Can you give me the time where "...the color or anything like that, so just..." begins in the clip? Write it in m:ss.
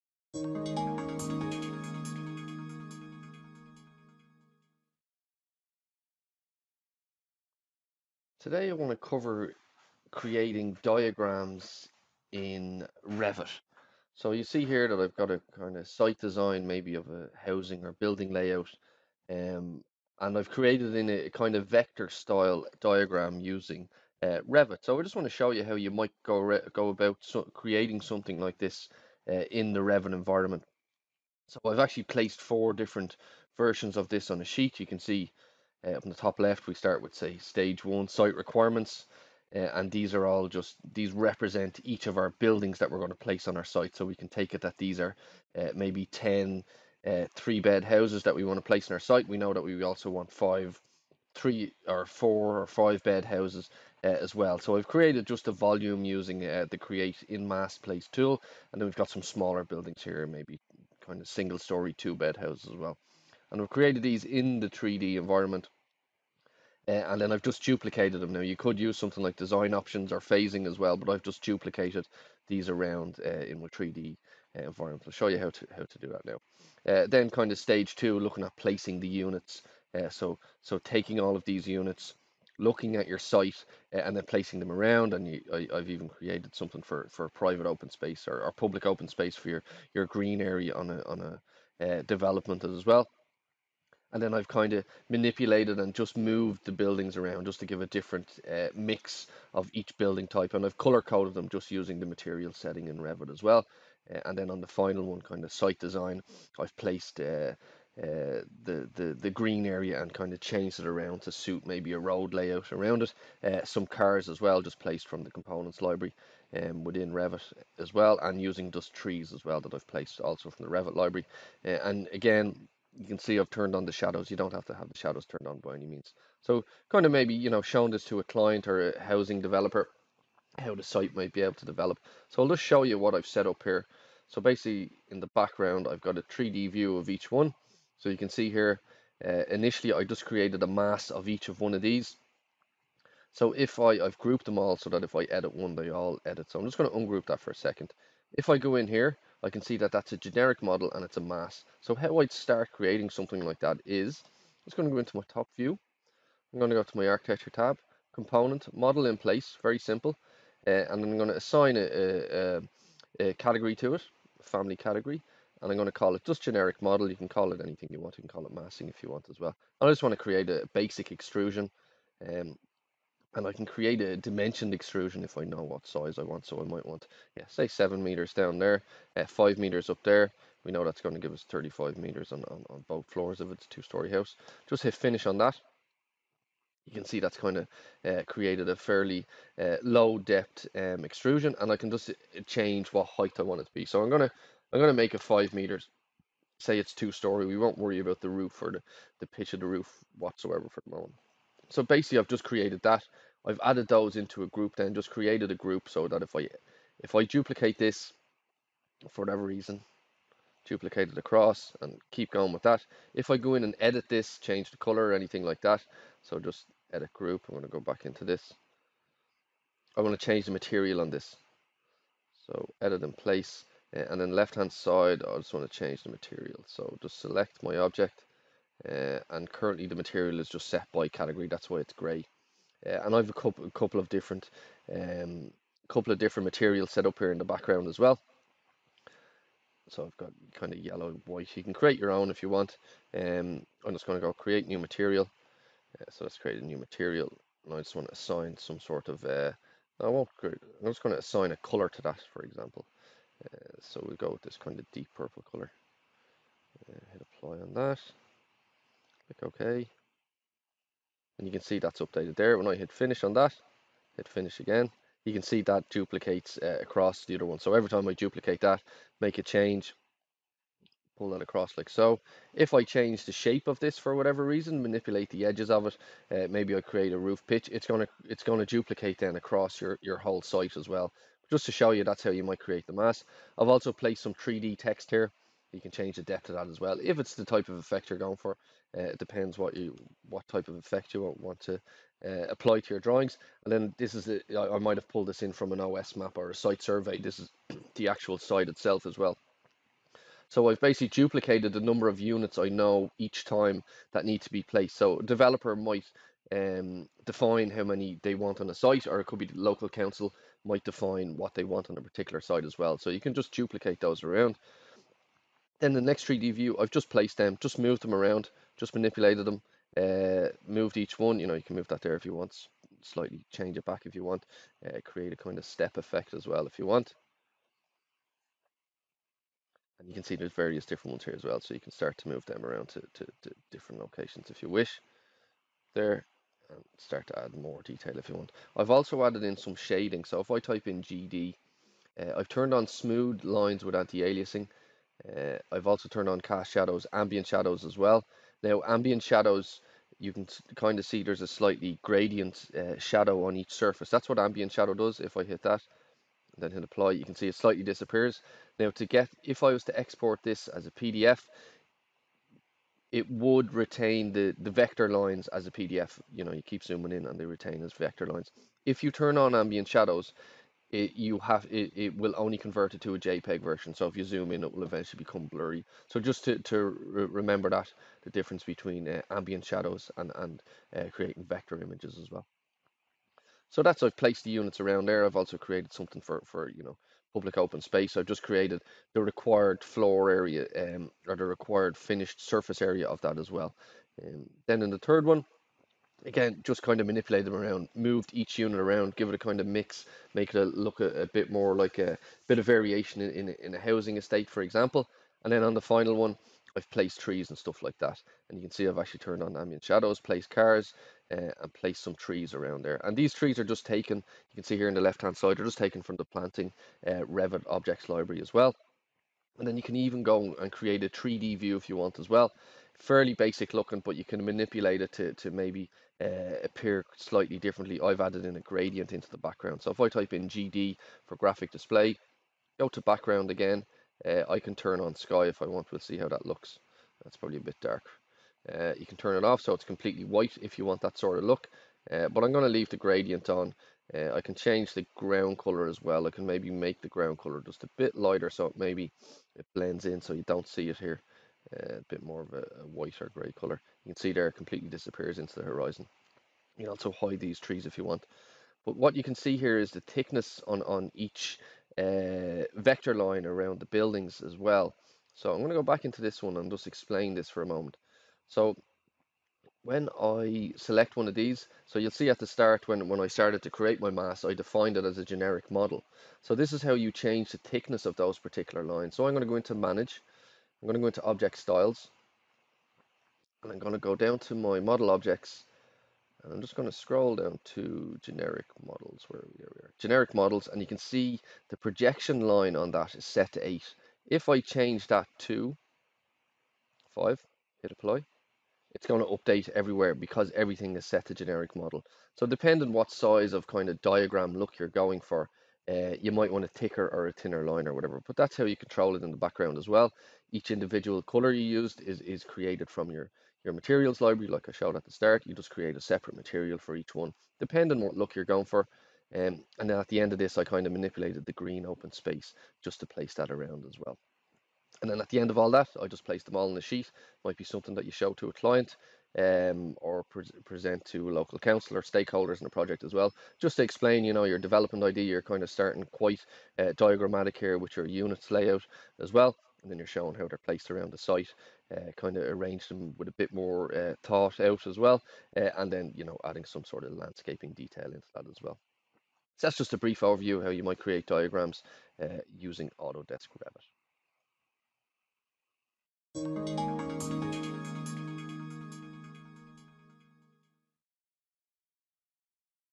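3:34.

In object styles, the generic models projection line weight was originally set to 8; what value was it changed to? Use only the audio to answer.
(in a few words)
5.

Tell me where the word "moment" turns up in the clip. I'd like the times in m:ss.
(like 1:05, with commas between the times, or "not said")
3:20, 7:47.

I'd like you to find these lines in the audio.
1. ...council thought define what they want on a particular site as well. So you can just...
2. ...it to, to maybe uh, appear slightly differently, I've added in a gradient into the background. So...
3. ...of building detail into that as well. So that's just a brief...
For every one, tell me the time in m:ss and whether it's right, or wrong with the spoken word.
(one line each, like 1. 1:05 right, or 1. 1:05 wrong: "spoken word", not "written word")
1. 5:09 wrong: "might", not "thought"
2. 7:05 right
3. 9:07 wrong: "landscaping", not "building".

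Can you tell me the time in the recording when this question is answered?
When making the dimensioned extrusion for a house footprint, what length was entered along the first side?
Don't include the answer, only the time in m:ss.
2:57.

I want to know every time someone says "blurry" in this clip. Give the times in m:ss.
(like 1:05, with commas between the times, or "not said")
6:15.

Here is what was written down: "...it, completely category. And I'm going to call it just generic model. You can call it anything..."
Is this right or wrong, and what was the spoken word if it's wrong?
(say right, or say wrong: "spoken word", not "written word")
wrong: "family", not "completely".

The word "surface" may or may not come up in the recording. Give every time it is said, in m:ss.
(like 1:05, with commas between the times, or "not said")
5:53, 6:32.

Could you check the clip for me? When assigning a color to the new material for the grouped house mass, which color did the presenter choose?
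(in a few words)
deep purple.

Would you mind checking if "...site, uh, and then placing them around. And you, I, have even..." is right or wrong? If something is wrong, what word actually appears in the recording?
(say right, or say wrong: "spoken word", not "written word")
right.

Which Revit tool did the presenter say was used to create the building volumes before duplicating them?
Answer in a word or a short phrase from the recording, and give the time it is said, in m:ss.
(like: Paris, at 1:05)
create in mass place, at 0:56.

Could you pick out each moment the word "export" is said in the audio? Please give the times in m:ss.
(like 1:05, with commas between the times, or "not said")
5:59.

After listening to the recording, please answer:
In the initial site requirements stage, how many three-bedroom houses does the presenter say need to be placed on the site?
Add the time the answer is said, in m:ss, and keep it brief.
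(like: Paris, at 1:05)
10, at 0:46.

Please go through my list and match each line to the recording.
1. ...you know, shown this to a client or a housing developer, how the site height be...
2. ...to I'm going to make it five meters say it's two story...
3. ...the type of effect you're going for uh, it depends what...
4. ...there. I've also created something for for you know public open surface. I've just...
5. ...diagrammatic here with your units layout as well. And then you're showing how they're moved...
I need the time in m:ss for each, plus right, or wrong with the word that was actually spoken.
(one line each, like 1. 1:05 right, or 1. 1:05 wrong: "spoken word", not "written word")
1. 2:07 wrong: "might", not "height"
2. 3:14 right
3. 4:47 right
4. 6:25 wrong: "space", not "surface"
5. 8:56 wrong: "placed", not "moved".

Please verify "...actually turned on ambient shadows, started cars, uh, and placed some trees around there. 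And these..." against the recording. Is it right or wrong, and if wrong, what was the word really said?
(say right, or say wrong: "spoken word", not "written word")
wrong: "placed", not "started".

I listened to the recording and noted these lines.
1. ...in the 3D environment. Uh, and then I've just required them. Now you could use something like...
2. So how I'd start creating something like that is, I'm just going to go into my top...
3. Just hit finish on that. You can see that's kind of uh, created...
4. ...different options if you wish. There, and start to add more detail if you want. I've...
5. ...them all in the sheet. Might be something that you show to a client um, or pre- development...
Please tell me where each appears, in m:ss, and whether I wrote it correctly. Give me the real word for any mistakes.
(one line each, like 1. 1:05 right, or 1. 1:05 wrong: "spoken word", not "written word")
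1. 1:04 wrong: "duplicated", not "required"
2. 2:31 right
3. 3:04 right
4. 5:33 wrong: "locations", not "options"
5. 8:46 wrong: "present", not "development".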